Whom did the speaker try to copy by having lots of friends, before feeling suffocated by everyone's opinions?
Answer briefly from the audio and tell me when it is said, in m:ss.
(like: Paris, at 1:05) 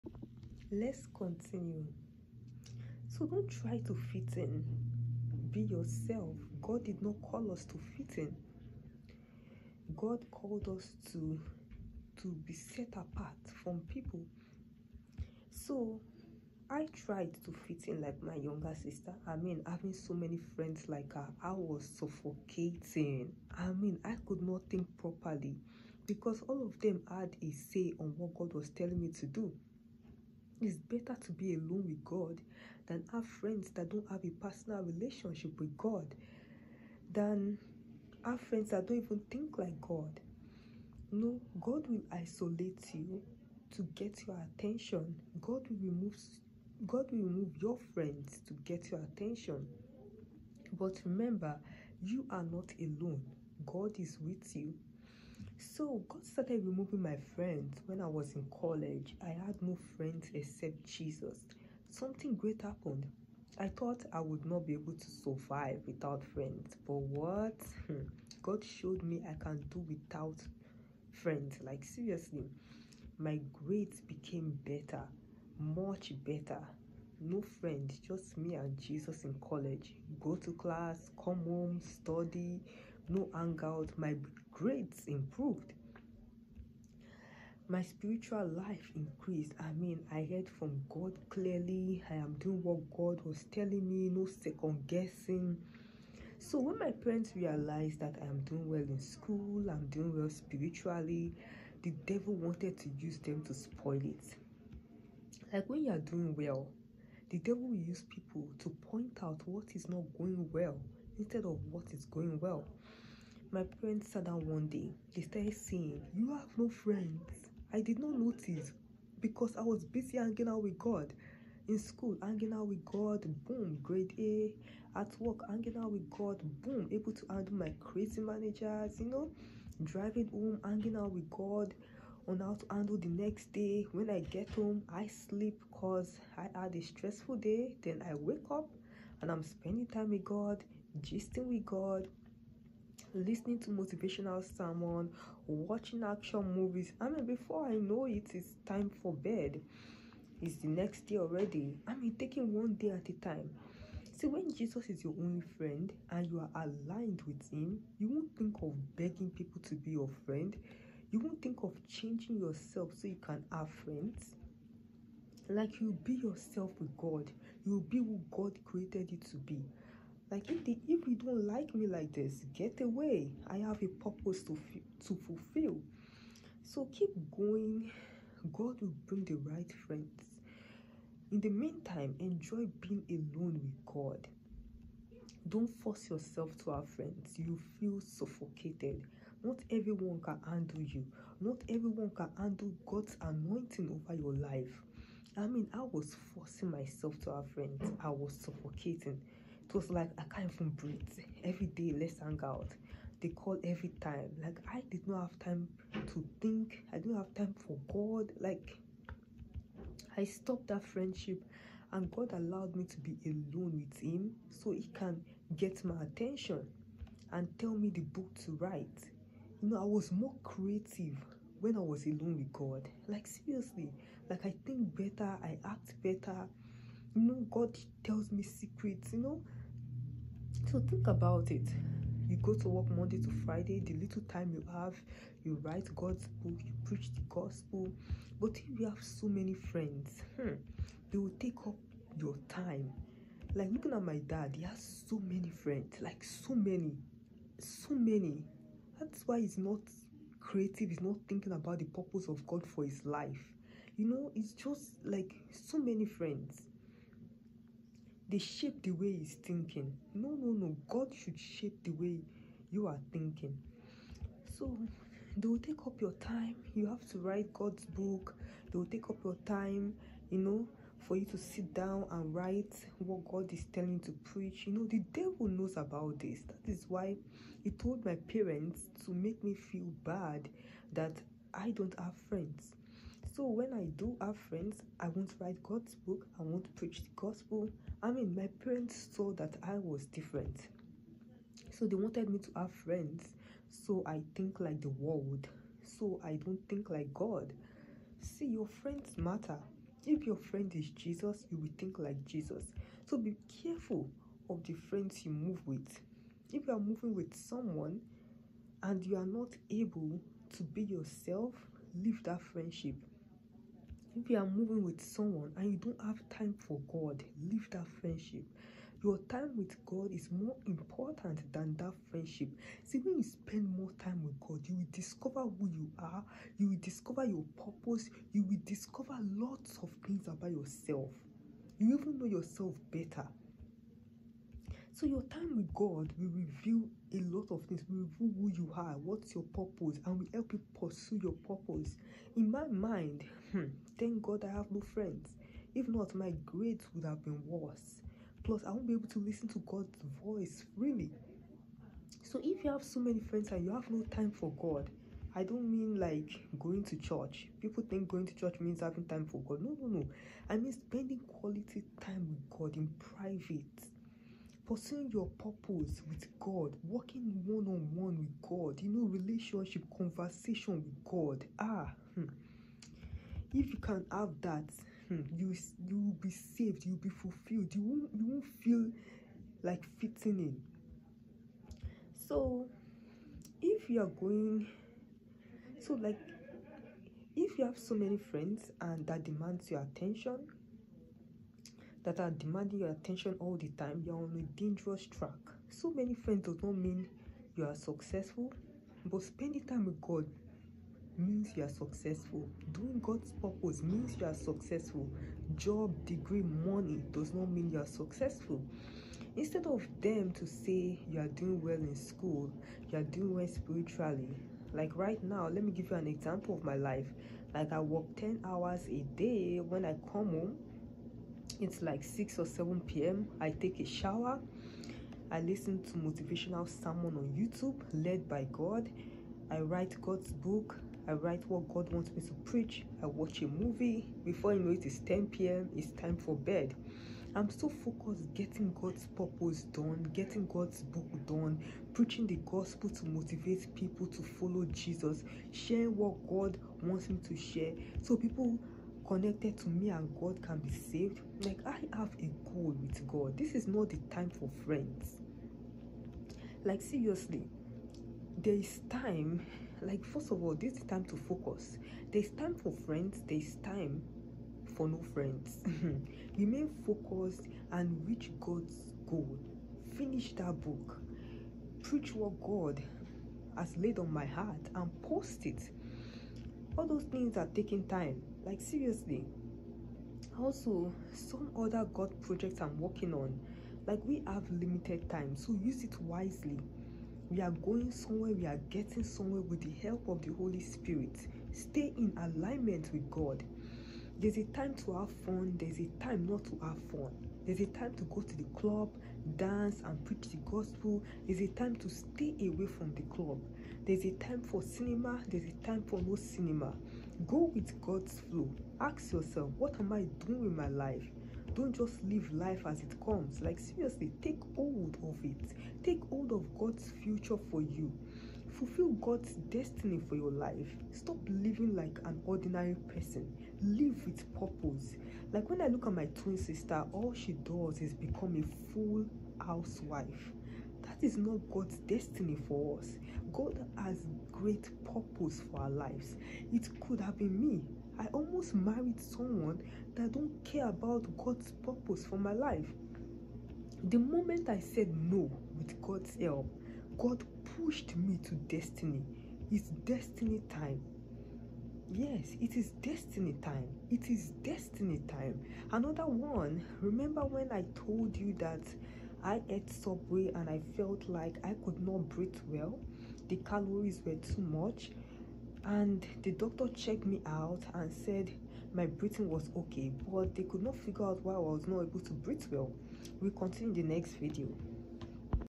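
Younger sister, at 0:18.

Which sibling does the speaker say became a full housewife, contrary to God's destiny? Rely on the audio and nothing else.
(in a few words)
Twin sister.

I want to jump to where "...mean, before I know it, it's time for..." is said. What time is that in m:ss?
2:27.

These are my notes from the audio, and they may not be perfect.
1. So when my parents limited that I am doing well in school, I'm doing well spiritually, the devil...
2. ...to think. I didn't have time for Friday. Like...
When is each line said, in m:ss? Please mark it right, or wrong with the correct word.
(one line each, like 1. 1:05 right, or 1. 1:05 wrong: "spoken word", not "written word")
1. 1:36 wrong: "realized", not "limited"
2. 3:26 wrong: "God", not "Friday".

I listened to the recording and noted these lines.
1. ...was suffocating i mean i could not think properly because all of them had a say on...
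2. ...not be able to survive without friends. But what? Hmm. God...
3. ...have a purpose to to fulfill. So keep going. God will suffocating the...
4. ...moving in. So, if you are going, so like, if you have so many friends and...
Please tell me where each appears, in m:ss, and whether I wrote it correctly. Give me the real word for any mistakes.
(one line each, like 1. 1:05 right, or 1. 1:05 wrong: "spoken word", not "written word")
1. 0:21 right
2. 1:04 right
3. 2:53 wrong: "bring", not "suffocating"
4. 6:19 wrong: "fitting", not "moving".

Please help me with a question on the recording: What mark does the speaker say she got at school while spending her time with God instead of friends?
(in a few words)
Grade A.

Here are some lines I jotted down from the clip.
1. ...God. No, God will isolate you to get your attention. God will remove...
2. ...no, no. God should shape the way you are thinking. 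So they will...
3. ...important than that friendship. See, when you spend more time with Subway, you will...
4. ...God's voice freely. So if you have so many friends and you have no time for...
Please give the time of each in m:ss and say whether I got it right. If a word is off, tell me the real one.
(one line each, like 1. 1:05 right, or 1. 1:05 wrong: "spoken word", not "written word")
1. 0:39 right
2. 4:20 right
3. 5:20 wrong: "God", not "Subway"
4. 5:49 right.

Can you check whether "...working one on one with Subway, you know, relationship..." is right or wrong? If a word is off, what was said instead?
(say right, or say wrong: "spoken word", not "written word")
wrong: "God", not "Subway".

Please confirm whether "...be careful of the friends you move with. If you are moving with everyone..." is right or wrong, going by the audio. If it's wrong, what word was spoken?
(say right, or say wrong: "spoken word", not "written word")
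wrong: "someone", not "everyone".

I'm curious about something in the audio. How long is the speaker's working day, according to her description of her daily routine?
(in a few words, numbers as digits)
10 hours.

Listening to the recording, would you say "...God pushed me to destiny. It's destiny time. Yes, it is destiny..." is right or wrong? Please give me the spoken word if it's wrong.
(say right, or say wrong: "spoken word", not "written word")
right.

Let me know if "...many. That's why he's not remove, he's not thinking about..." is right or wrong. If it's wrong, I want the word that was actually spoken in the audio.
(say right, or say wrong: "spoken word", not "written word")
wrong: "creative", not "remove".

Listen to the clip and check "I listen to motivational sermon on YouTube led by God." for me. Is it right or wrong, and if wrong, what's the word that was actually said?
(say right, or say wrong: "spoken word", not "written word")
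right.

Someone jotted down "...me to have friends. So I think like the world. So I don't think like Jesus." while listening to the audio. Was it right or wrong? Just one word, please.
wrong.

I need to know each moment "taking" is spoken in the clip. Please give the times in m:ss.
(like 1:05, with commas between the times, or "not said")
2:32, 7:57.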